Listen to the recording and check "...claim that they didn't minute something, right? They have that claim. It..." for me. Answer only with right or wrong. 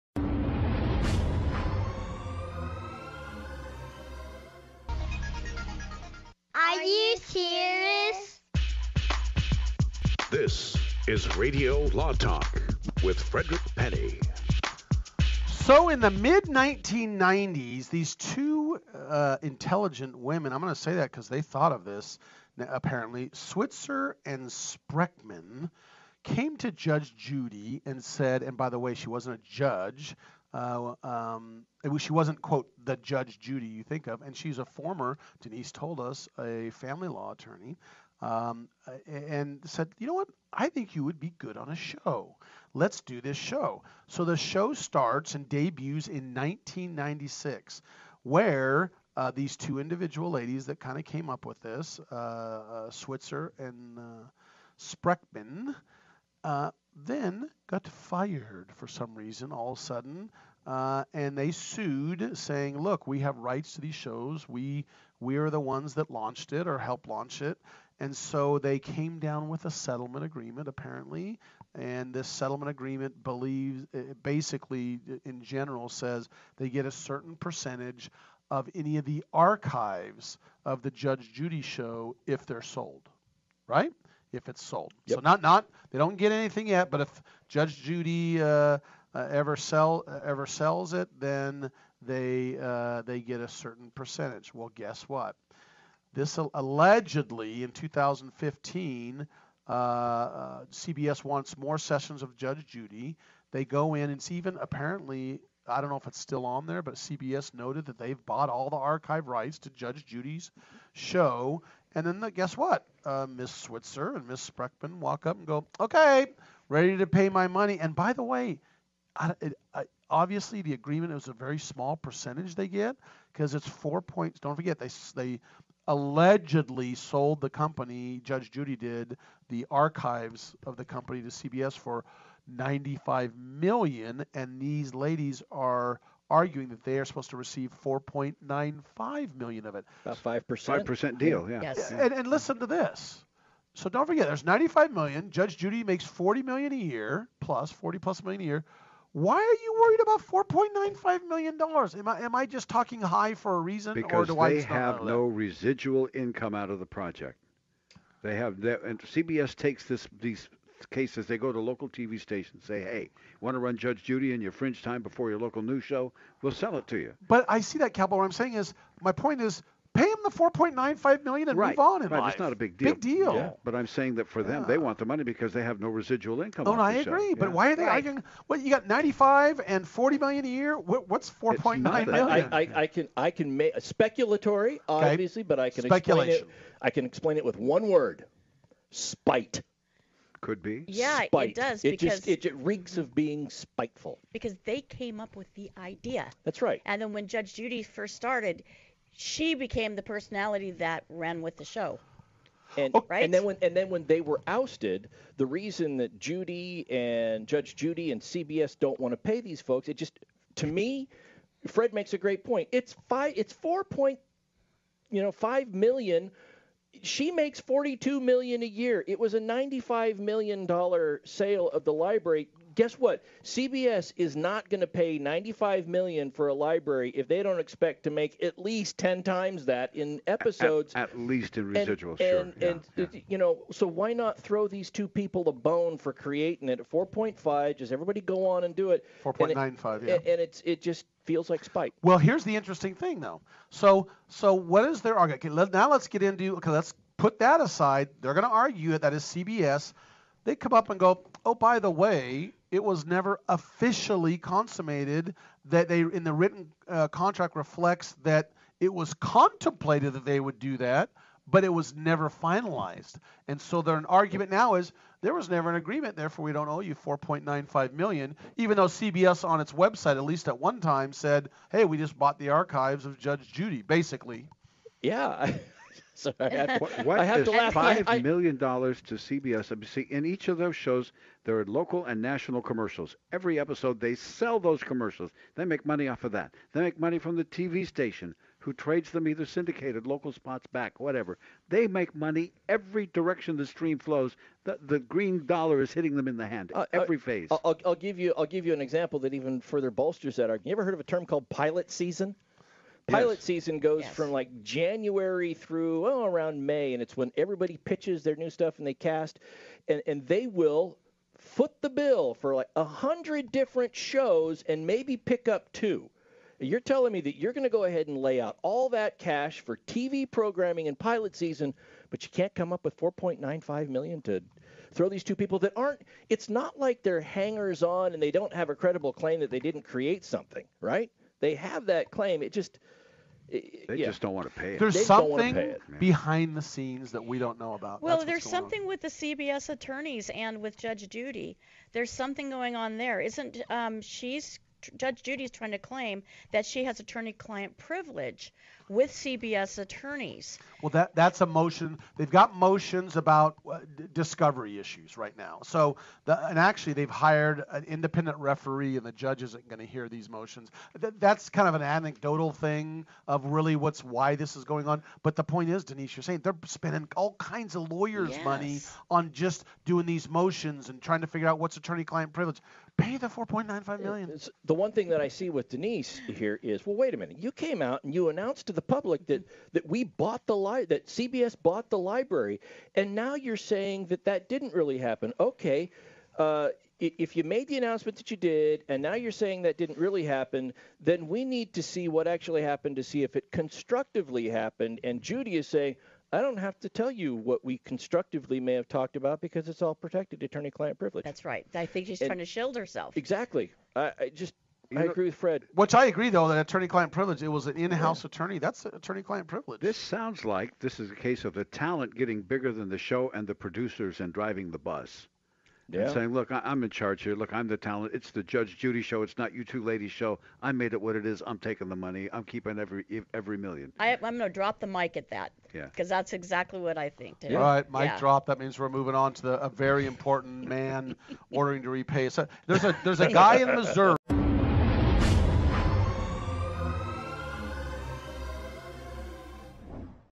wrong.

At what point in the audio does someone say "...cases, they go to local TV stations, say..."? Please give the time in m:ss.
2:40.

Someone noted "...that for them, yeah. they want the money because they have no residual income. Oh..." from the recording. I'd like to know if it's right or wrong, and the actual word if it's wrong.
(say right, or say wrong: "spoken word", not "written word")
right.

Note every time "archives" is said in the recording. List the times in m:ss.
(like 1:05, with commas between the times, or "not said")
1:19, 1:48, 2:09, 4:32.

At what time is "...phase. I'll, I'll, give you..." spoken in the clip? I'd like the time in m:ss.
4:57.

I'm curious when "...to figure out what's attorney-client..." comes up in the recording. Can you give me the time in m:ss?
6:11.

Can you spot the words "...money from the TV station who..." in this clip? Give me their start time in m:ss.
4:46.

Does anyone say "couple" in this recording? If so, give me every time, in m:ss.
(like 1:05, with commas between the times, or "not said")
not said.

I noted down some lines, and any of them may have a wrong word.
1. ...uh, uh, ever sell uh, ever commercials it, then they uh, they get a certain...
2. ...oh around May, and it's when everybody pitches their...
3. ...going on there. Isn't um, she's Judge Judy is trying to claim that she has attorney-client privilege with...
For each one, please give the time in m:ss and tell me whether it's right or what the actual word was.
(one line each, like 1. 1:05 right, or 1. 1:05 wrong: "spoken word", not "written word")
1. 1:28 wrong: "sells", not "commercials"
2. 5:06 right
3. 5:42 right.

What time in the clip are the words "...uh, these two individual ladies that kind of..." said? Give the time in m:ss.
0:49.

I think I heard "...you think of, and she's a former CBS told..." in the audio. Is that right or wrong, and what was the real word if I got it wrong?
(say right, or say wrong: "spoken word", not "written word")
wrong: "Denise", not "CBS".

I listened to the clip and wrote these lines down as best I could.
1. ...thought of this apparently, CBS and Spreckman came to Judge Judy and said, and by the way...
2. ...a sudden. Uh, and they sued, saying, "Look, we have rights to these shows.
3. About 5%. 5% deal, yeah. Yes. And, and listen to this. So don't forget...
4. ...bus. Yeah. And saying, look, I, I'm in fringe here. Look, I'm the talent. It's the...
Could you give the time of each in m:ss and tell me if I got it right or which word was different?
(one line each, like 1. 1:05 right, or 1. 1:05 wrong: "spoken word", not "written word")
1. 0:21 wrong: "Switzer", not "CBS"
2. 0:59 right
3. 2:20 right
4. 6:54 wrong: "charge", not "fringe".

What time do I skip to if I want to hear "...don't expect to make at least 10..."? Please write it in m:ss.
3:47.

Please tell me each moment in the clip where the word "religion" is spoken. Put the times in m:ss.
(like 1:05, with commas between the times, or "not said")
not said.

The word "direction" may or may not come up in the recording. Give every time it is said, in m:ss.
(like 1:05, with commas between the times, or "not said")
4:53.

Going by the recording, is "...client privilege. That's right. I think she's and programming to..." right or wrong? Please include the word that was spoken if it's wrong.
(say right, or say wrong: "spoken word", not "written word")
wrong: "trying", not "programming".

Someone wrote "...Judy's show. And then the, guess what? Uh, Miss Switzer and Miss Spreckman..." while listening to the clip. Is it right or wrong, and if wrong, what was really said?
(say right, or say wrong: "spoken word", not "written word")
right.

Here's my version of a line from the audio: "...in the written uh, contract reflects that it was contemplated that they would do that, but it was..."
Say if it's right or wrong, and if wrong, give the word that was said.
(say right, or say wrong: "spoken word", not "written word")
right.